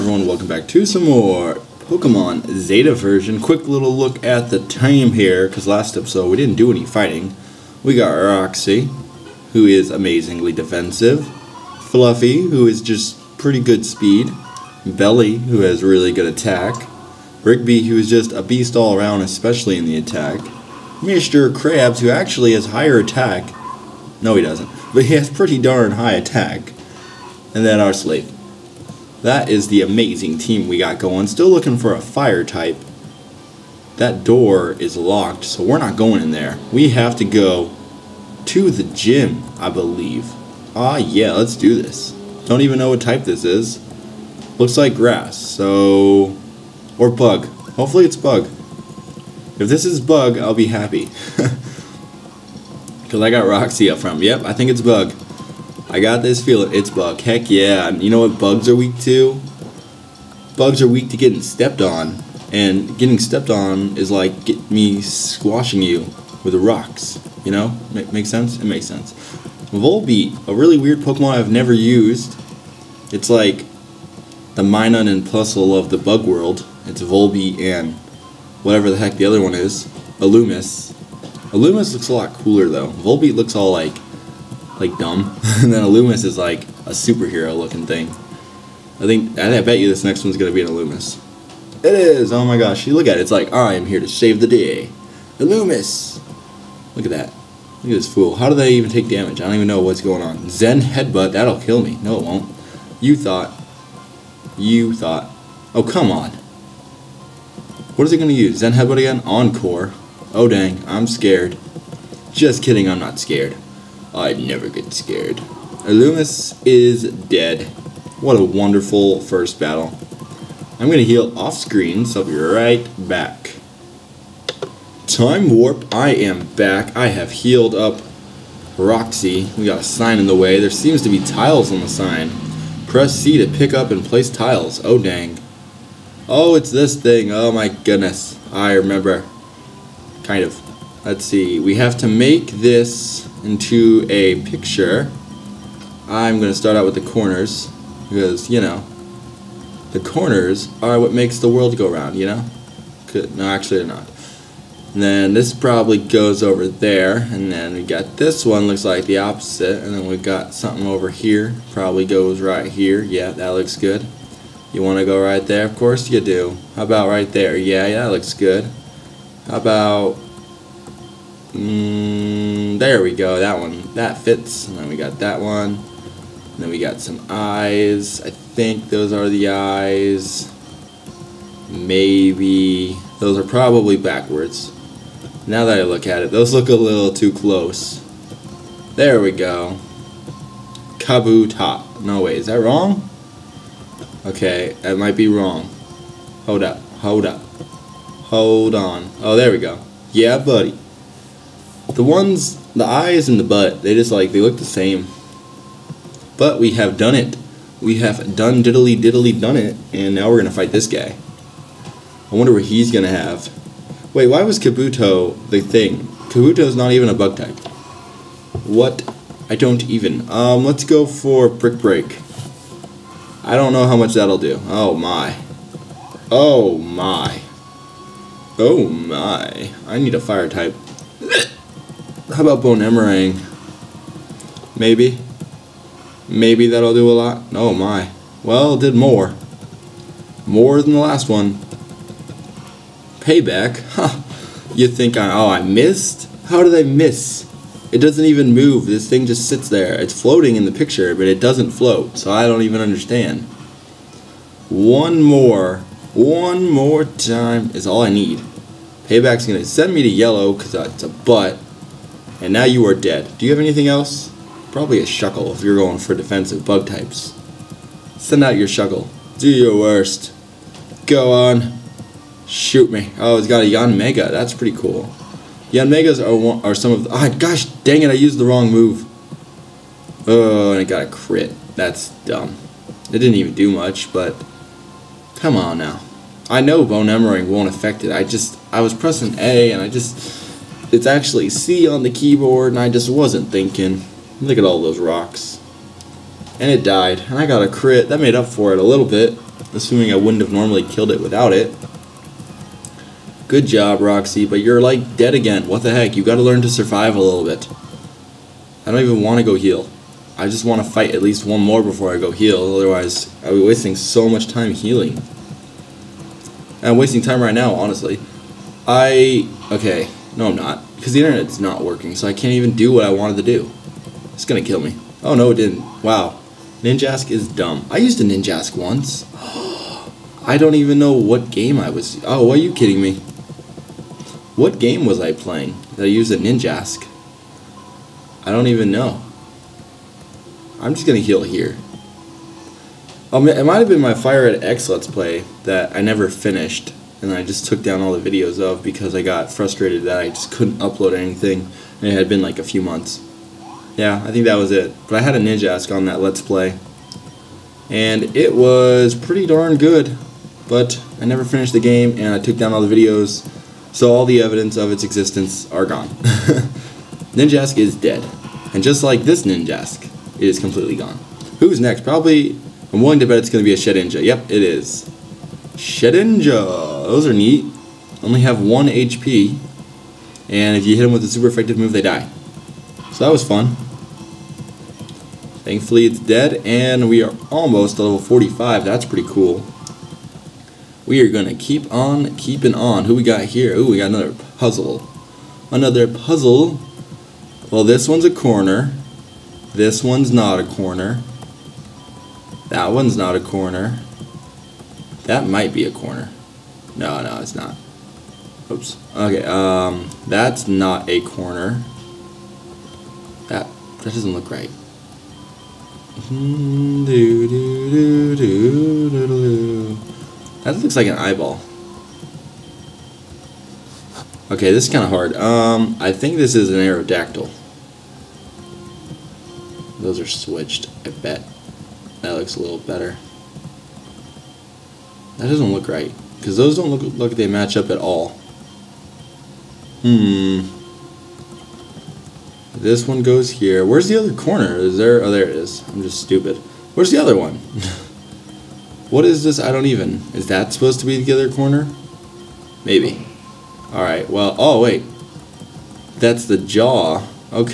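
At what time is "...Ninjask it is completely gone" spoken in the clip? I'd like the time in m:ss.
6:09.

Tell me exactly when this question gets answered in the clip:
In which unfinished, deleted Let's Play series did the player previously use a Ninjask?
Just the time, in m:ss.
5:44.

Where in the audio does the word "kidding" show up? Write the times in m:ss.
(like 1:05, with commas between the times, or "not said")
1:52, 5:32.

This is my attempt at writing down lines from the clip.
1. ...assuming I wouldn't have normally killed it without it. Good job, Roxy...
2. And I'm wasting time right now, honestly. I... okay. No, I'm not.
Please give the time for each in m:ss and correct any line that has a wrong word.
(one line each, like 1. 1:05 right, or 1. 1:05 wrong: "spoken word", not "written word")
1. 4:59 right
2. 5:16 right.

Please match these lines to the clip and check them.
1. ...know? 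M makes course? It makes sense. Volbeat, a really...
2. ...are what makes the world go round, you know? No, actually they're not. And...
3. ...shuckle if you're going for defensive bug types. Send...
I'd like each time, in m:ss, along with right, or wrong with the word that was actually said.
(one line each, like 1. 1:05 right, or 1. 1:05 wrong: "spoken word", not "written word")
1. 1:07 wrong: "sense", not "course"
2. 2:30 right
3. 4:25 right.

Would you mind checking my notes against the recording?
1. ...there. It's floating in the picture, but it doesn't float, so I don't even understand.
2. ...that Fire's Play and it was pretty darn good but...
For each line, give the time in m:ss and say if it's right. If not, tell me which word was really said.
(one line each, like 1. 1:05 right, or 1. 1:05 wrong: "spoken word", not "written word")
1. 4:09 right
2. 5:56 wrong: "Let", not "Fire".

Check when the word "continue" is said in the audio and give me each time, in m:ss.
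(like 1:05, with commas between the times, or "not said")
not said.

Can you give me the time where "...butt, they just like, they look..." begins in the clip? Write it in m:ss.
3:23.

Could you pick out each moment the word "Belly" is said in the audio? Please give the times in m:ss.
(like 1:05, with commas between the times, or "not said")
0:14.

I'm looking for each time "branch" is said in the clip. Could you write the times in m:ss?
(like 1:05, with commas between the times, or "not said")
not said.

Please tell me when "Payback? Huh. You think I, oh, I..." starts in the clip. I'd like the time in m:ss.
4:03.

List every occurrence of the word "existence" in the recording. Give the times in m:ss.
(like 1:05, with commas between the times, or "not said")
6:05.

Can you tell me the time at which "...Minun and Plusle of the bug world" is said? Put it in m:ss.
1:14.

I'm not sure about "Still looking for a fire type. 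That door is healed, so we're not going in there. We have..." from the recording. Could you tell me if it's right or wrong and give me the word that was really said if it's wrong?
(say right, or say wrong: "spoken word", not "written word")
wrong: "locked", not "healed".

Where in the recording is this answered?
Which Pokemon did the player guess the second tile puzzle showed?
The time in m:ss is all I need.
7:06.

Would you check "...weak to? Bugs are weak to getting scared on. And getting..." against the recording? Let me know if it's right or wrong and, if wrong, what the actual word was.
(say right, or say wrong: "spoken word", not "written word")
wrong: "stepped", not "scared".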